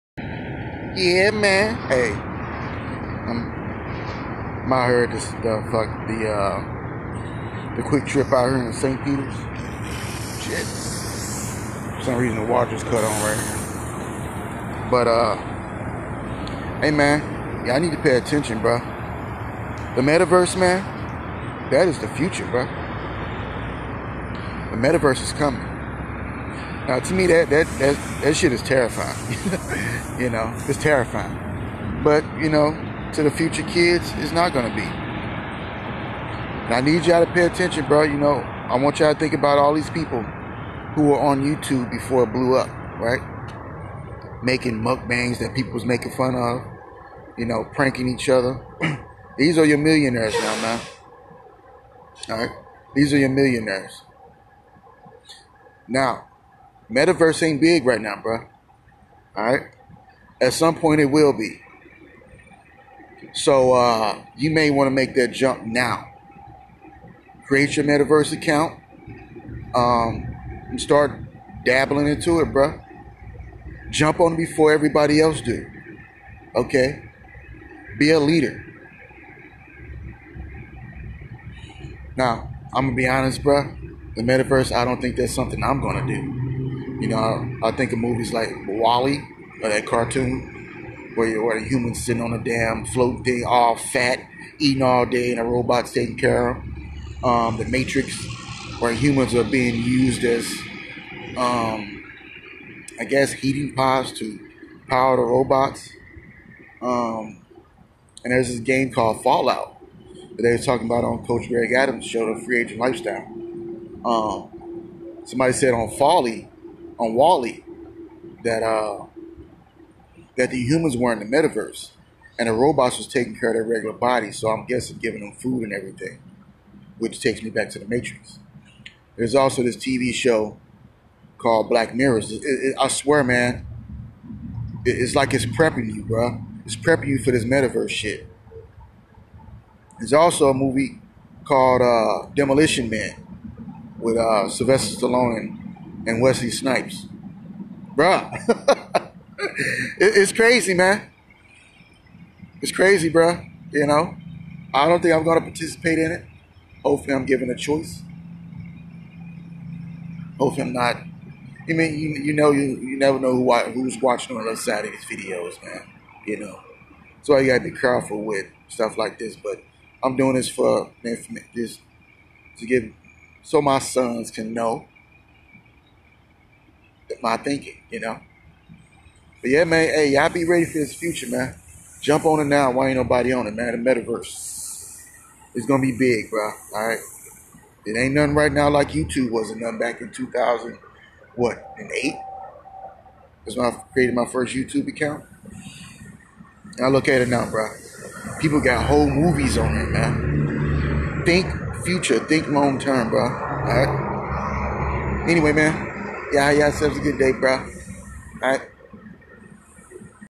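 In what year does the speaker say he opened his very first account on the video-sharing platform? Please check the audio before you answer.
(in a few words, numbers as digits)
2008.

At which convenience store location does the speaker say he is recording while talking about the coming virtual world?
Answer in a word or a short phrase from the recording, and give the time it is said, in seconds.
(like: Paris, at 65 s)
QuikTrip, at 7 s.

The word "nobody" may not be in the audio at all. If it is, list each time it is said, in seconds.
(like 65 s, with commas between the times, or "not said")
182 s.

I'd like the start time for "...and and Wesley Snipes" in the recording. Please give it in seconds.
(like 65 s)
145 s.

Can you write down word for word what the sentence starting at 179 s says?
But yeah, man, hey, y'all be ready for this future, man.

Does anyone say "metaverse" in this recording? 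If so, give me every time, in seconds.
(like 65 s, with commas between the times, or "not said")
20 s, 24 s, 56 s, 67 s, 84 s, 121 s, 137 s, 183 s.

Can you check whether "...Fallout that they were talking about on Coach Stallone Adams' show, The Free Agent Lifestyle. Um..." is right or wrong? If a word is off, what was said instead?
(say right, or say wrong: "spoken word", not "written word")
wrong: "Greg", not "Stallone".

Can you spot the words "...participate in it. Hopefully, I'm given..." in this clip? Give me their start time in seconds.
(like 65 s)
155 s.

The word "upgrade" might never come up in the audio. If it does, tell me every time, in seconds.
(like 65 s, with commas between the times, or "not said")
not said.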